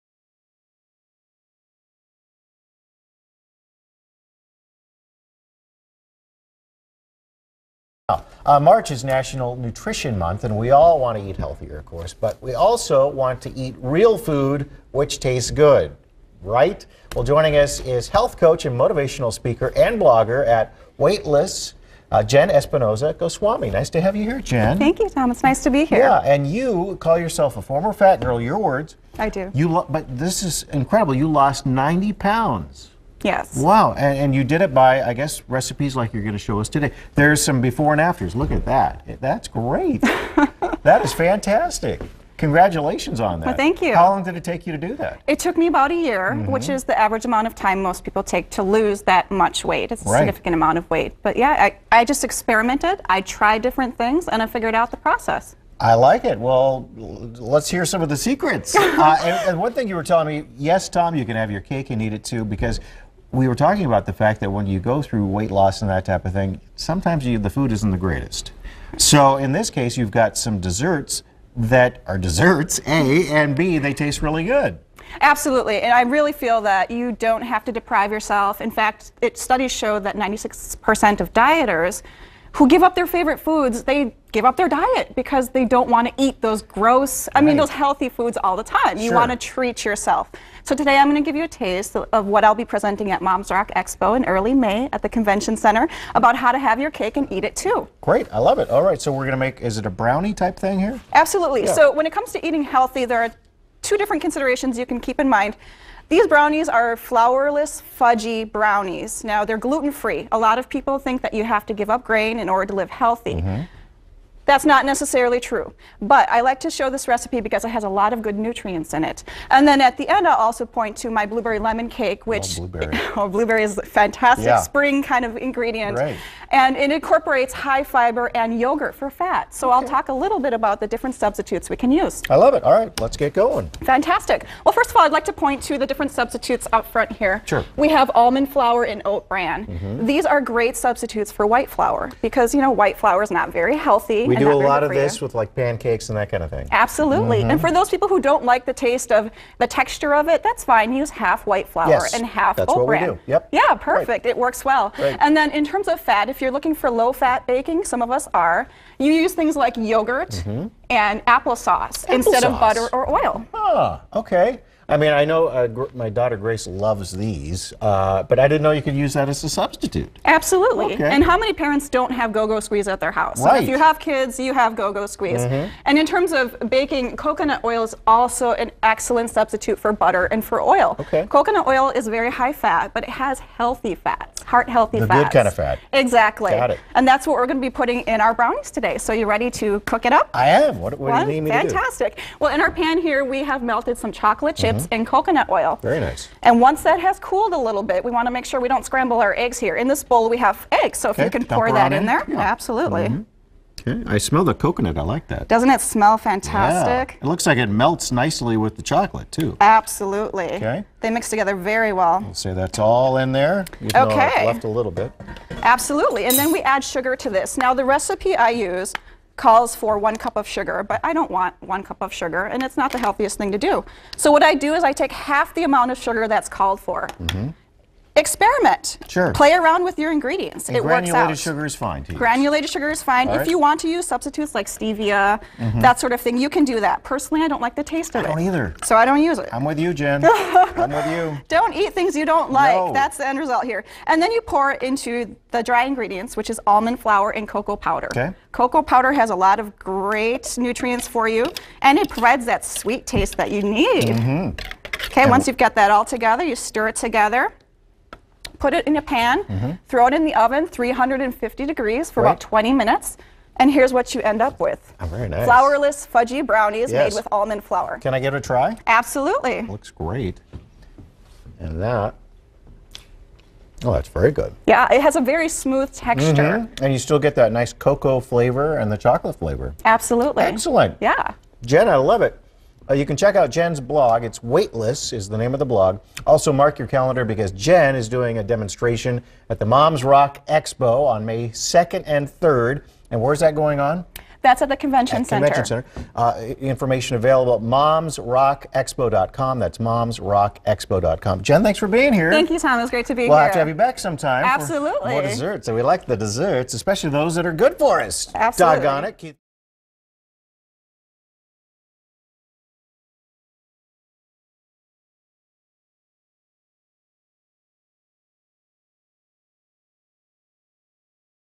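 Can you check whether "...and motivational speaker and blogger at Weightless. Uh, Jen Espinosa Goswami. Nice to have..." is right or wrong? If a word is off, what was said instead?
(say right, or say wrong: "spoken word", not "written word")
right.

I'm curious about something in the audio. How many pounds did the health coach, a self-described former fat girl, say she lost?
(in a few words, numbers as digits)
90.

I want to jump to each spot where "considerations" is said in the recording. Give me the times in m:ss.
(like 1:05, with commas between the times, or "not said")
1:44.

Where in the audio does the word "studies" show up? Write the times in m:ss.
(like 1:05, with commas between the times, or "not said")
1:19.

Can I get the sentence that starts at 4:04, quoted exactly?
And then you pour into the dry ingredients, which is almond flour and cocoa powder.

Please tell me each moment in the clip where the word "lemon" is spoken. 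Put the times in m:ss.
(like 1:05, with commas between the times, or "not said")
2:01.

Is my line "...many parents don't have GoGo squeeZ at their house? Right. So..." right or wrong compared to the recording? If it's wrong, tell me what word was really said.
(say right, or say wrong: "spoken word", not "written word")
right.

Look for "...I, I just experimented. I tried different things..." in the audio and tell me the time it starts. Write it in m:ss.
0:51.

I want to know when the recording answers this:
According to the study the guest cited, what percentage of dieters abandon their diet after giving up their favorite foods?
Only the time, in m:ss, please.
1:20.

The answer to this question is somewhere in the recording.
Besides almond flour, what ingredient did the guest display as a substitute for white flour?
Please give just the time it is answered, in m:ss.
2:19.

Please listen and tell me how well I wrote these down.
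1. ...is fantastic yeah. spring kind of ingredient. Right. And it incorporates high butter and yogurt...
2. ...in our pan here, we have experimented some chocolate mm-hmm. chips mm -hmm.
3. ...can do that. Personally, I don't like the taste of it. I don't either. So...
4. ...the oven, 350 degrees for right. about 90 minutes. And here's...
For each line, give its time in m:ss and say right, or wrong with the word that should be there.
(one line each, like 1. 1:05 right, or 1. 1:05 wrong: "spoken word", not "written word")
1. 2:03 wrong: "fiber", not "butter"
2. 3:12 wrong: "melted", not "experimented"
3. 3:56 right
4. 4:20 wrong: "20", not "90".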